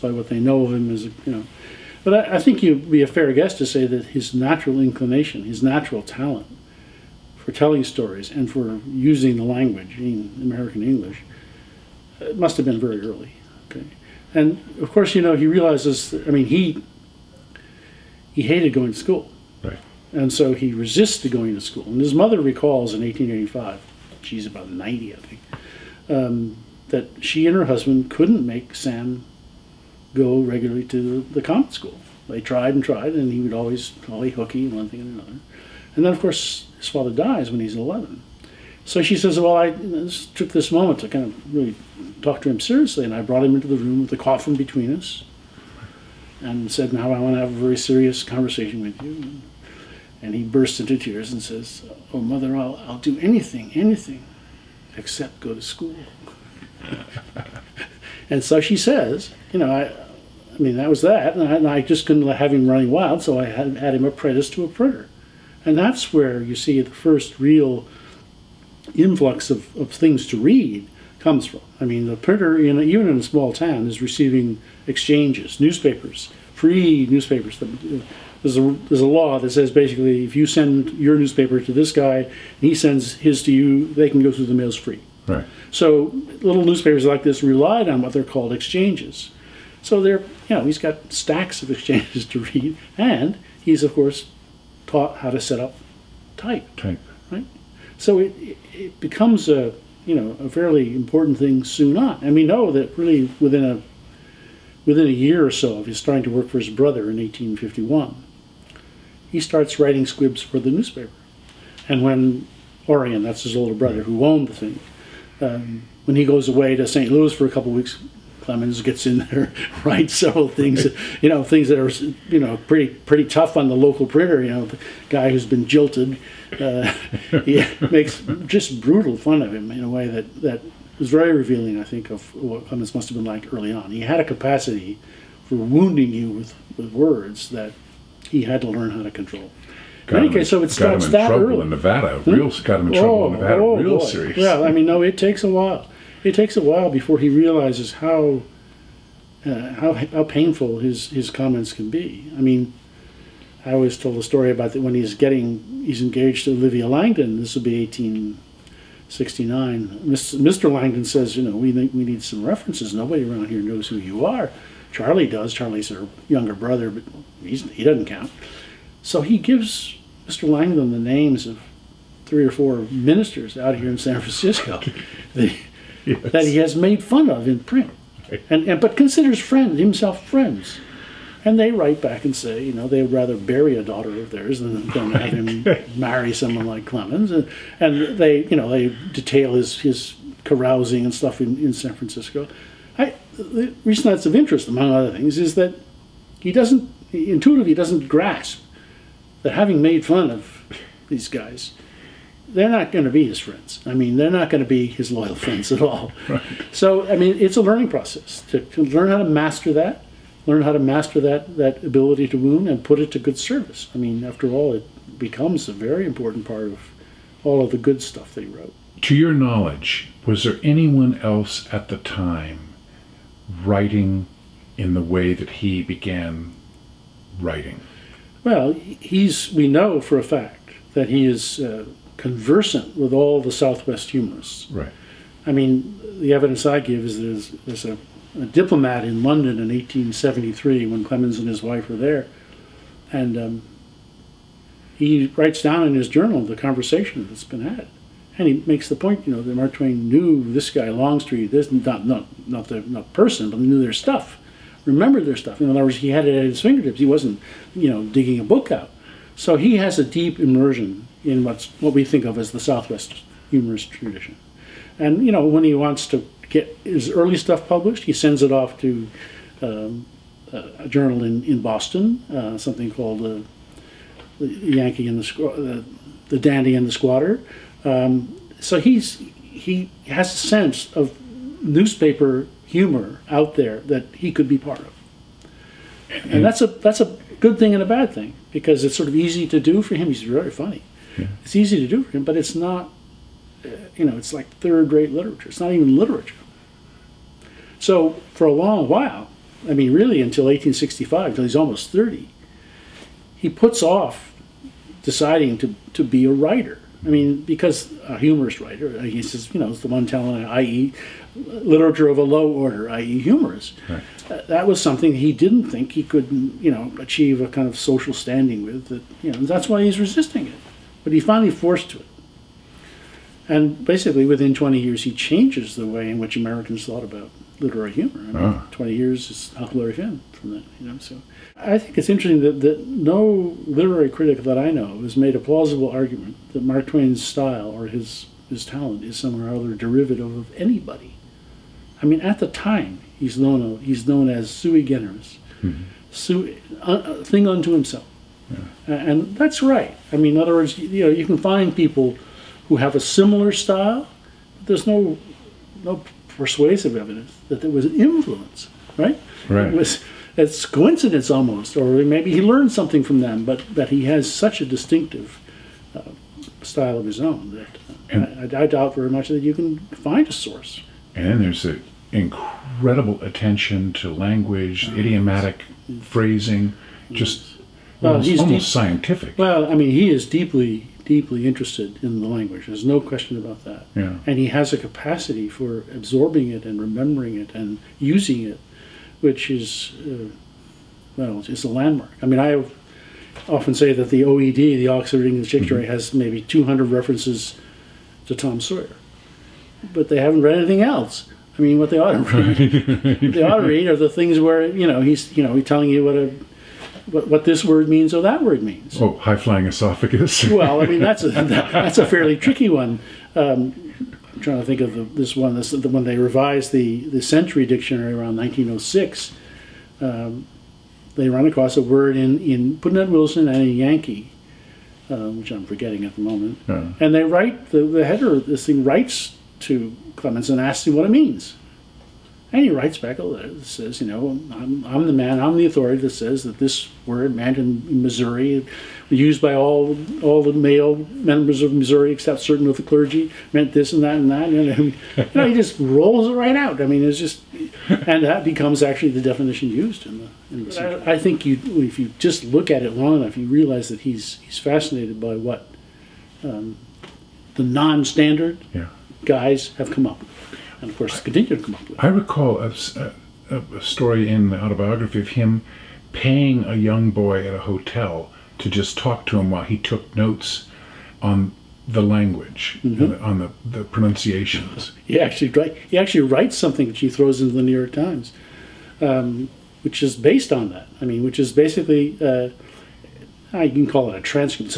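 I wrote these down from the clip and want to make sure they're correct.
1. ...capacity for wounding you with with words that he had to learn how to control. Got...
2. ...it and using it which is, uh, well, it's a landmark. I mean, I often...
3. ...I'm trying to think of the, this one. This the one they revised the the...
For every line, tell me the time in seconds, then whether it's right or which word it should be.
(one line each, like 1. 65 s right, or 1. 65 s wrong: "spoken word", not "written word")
1. 134 s right
2. 387 s right
3. 414 s right.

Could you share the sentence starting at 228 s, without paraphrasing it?
Well, he's we know for a fact that he is uh, conversant with all the Southwest humorists.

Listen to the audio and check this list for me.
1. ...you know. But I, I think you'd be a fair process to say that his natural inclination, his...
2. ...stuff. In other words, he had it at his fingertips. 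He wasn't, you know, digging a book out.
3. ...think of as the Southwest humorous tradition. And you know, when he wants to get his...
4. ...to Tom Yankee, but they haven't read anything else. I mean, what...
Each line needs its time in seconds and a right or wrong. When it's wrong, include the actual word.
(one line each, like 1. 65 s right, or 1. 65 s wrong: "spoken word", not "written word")
1. 1 s wrong: "guess", not "process"
2. 255 s right
3. 262 s right
4. 398 s wrong: "Sawyer", not "Yankee".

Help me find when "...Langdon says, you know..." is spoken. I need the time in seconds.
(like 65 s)
160 s.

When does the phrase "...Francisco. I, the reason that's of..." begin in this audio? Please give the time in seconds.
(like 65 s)
191 s.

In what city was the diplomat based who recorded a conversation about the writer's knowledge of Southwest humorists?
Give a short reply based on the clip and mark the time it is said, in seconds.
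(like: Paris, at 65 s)
London, at 239 s.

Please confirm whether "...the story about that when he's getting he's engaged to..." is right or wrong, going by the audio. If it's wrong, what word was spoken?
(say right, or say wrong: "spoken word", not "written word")
right.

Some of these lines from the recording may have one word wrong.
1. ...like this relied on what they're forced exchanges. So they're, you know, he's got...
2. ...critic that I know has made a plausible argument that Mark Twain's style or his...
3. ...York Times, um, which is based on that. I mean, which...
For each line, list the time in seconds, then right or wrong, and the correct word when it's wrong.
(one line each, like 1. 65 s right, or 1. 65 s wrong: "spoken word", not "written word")
1. 87 s wrong: "called", not "forced"
2. 334 s right
3. 477 s right.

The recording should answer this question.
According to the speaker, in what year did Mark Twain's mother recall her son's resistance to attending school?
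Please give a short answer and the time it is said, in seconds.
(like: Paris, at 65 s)
1885, at 23 s.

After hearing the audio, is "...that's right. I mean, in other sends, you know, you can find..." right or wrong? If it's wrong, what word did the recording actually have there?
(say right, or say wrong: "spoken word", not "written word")
wrong: "words", not "sends".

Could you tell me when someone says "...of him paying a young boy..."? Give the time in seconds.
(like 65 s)
465 s.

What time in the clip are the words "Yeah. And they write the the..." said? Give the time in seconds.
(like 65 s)
426 s.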